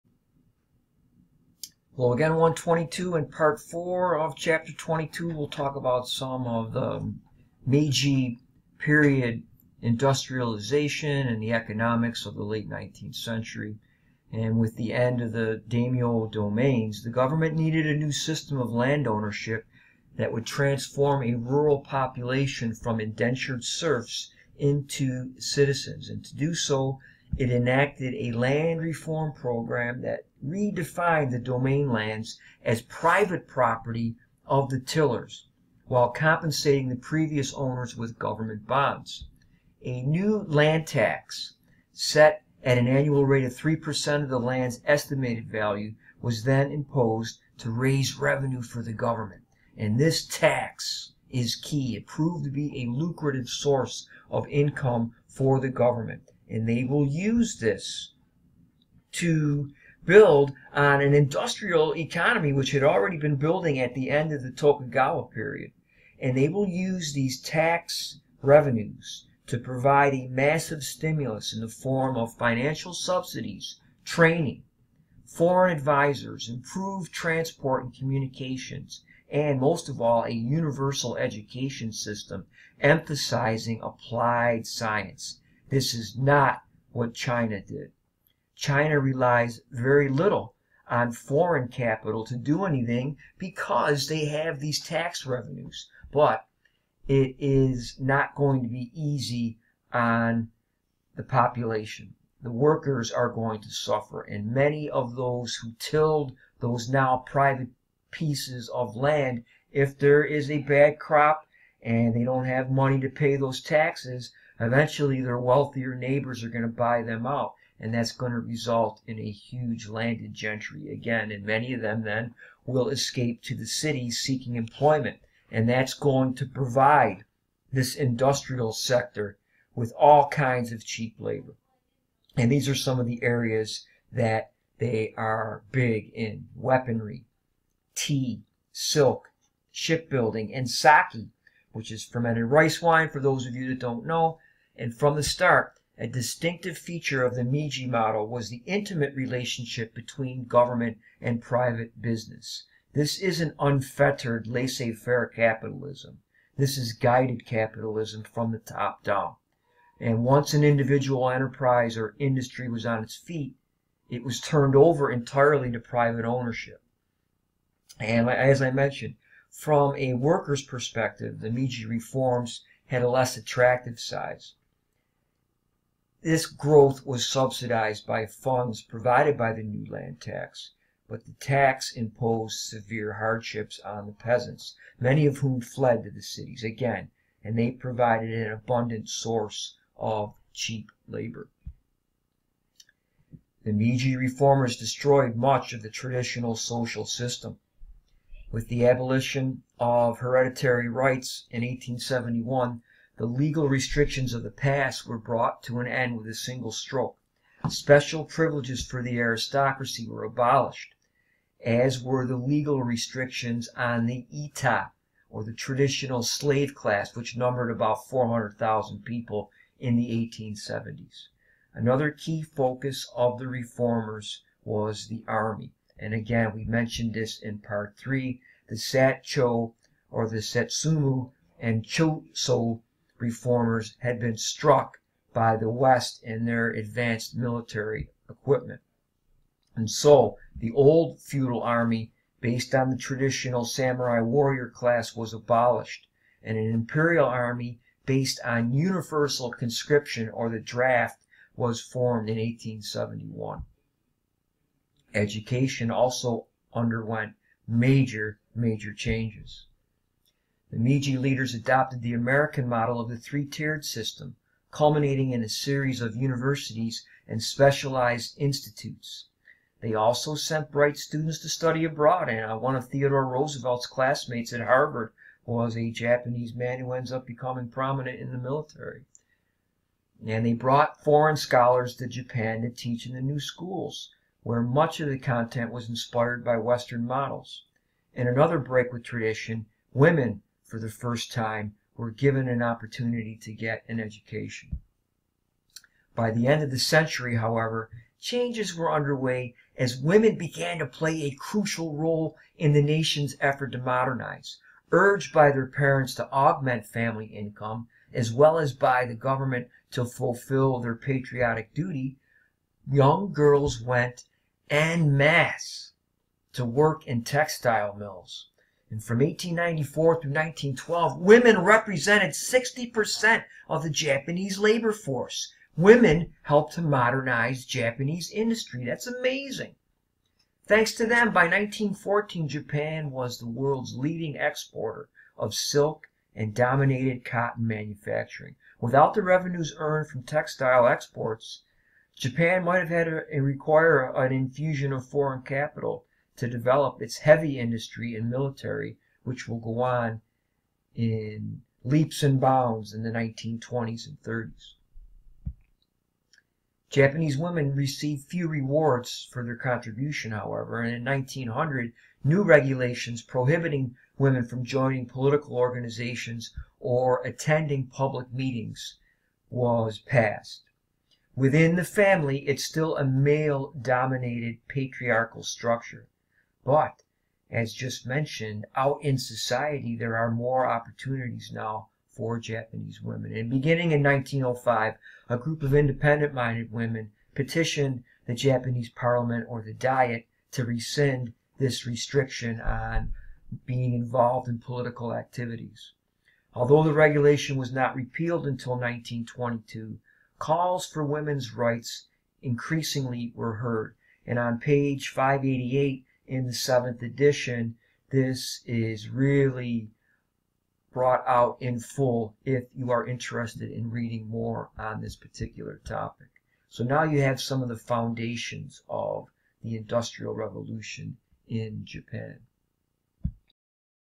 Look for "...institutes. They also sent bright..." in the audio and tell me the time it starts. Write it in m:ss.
4:28.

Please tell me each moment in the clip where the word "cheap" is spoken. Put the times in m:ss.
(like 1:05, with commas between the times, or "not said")
2:10, 3:10.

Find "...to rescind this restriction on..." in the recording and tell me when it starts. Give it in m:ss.
6:30.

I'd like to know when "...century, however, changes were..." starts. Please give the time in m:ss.
4:56.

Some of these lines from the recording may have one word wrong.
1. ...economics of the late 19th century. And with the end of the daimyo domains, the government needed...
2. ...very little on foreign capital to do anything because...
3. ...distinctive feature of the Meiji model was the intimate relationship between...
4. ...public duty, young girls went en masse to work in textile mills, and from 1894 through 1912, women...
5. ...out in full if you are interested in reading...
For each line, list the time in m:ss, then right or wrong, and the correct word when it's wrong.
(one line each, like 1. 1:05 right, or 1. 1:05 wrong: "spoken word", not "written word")
1. 0:11 right
2. 1:29 right
3. 2:26 right
4. 5:10 wrong: "patriotic", not "public"
5. 6:51 right.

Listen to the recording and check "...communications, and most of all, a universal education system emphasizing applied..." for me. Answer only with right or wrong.
right.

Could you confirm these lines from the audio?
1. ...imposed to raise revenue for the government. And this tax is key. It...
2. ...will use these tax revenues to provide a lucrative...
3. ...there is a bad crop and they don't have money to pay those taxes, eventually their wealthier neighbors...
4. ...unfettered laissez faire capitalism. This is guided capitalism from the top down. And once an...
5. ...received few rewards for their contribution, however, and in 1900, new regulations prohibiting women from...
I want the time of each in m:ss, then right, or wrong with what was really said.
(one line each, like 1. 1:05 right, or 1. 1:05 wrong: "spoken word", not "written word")
1. 0:46 right
2. 1:06 wrong: "massive", not "lucrative"
3. 1:49 right
4. 2:33 right
5. 5:57 right.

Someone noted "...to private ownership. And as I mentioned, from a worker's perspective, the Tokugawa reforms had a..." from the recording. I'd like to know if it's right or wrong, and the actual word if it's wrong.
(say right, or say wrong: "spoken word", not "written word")
wrong: "Meiji", not "Tokugawa".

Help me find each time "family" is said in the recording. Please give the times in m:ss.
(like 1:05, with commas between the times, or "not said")
5:06, 6:11.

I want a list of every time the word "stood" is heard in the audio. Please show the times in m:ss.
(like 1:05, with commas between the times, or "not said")
not said.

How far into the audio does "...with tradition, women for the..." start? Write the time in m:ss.
4:48.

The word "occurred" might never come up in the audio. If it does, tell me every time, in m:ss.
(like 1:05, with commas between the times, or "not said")
not said.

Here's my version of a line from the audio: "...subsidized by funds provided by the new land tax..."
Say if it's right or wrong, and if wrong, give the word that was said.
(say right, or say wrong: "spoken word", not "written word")
right.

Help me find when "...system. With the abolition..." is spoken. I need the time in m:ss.
3:17.